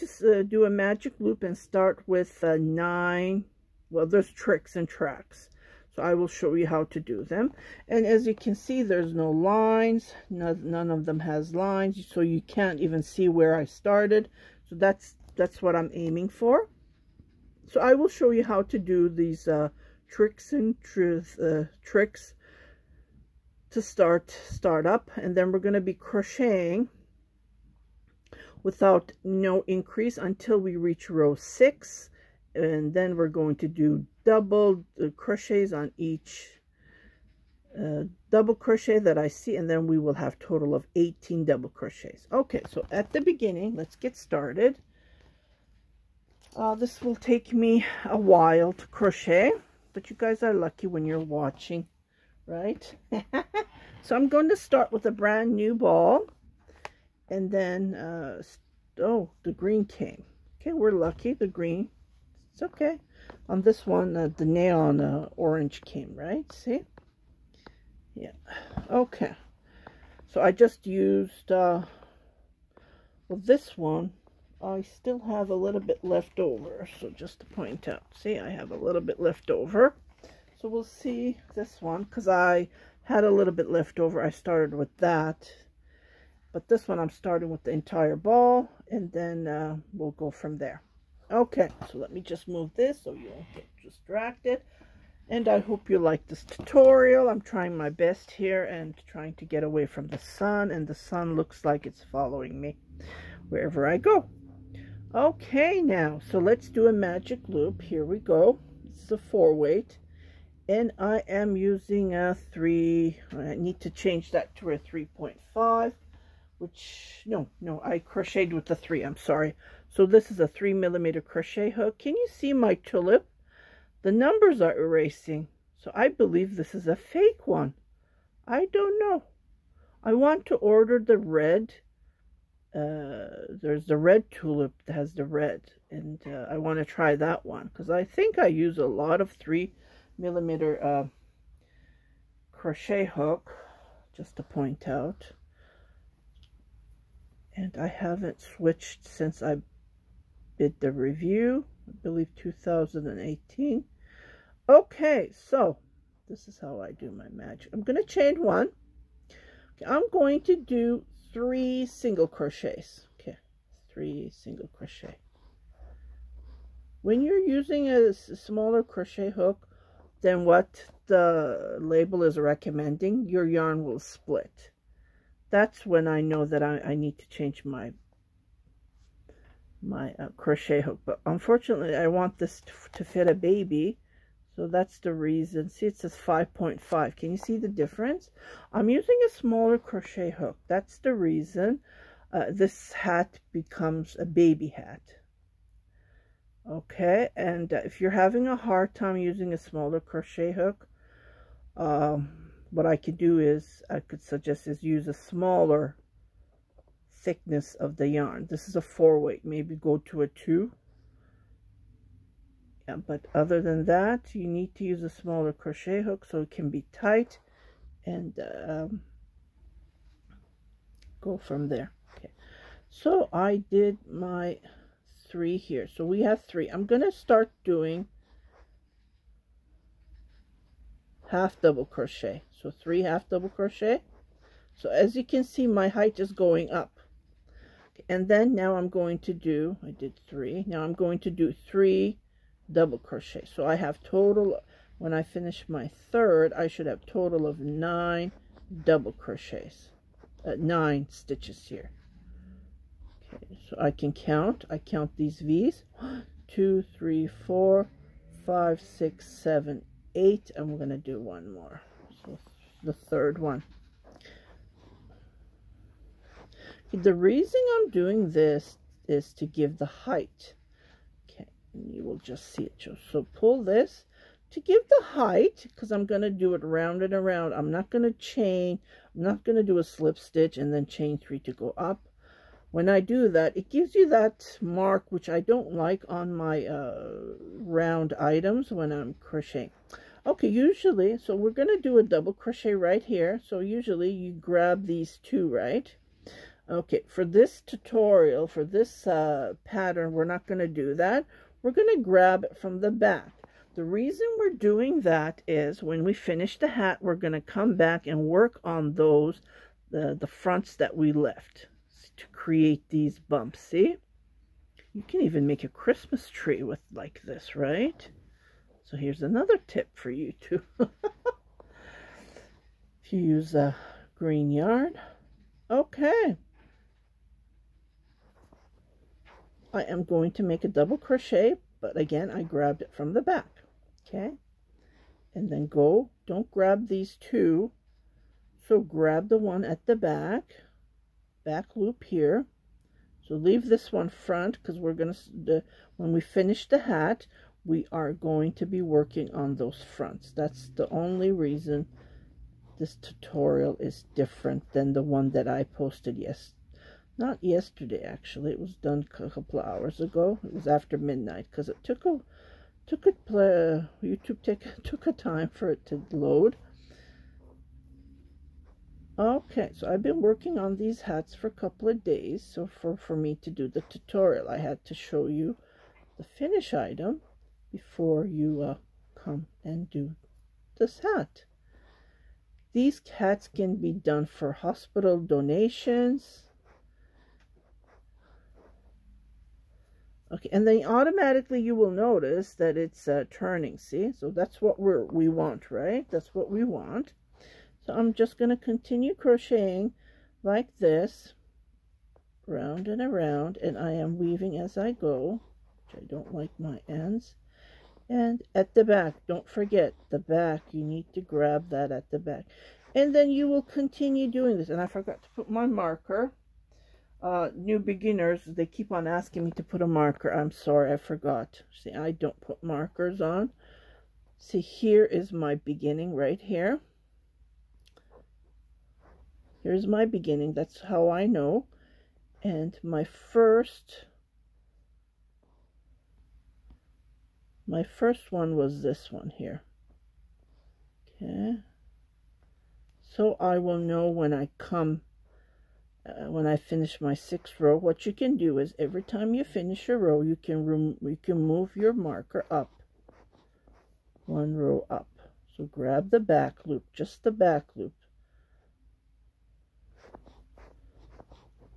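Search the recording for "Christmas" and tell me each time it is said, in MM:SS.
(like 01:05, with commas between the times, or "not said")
05:15.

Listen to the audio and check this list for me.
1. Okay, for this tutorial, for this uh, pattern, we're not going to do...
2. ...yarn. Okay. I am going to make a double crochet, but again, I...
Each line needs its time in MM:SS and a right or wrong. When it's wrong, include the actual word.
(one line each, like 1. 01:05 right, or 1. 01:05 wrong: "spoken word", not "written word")
1. 04:56 right
2. 05:24 right.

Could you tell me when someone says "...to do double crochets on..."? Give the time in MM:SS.
00:33.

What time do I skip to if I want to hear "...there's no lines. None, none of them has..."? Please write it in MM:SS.
00:08.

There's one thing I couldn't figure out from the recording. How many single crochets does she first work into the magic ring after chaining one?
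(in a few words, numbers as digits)
3.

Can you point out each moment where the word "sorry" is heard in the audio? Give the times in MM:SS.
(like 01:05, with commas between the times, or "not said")
01:59, 07:00.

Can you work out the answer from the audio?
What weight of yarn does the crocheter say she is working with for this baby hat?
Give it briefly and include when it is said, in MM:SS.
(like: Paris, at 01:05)
4 weight, at 01:48.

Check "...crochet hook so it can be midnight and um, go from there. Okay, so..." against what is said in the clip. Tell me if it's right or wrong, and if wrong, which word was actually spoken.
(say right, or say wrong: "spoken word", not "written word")
wrong: "tight", not "midnight".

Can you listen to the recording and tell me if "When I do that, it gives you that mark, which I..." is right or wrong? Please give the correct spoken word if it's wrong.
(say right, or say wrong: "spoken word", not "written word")
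right.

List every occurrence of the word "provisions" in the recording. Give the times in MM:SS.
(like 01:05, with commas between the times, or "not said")
not said.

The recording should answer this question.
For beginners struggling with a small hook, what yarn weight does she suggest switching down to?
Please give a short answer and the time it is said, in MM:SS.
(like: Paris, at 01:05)
2, at 03:29.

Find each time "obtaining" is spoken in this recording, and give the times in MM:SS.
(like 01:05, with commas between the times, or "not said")
not said.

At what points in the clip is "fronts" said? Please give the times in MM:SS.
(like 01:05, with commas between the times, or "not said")
05:10, 05:44, 05:49.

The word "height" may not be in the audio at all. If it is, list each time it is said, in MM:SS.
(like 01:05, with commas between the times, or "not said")
03:55, 04:29, 04:35.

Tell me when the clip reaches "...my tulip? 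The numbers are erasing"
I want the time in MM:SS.
02:02.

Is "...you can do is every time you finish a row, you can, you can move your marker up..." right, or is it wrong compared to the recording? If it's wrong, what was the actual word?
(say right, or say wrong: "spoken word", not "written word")
right.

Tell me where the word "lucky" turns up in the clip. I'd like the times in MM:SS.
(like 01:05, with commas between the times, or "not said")
00:50, 01:00.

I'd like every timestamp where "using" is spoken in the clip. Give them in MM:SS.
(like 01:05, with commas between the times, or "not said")
01:51, 02:47, 03:08, 03:19.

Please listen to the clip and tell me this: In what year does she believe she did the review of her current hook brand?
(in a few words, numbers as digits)
2018.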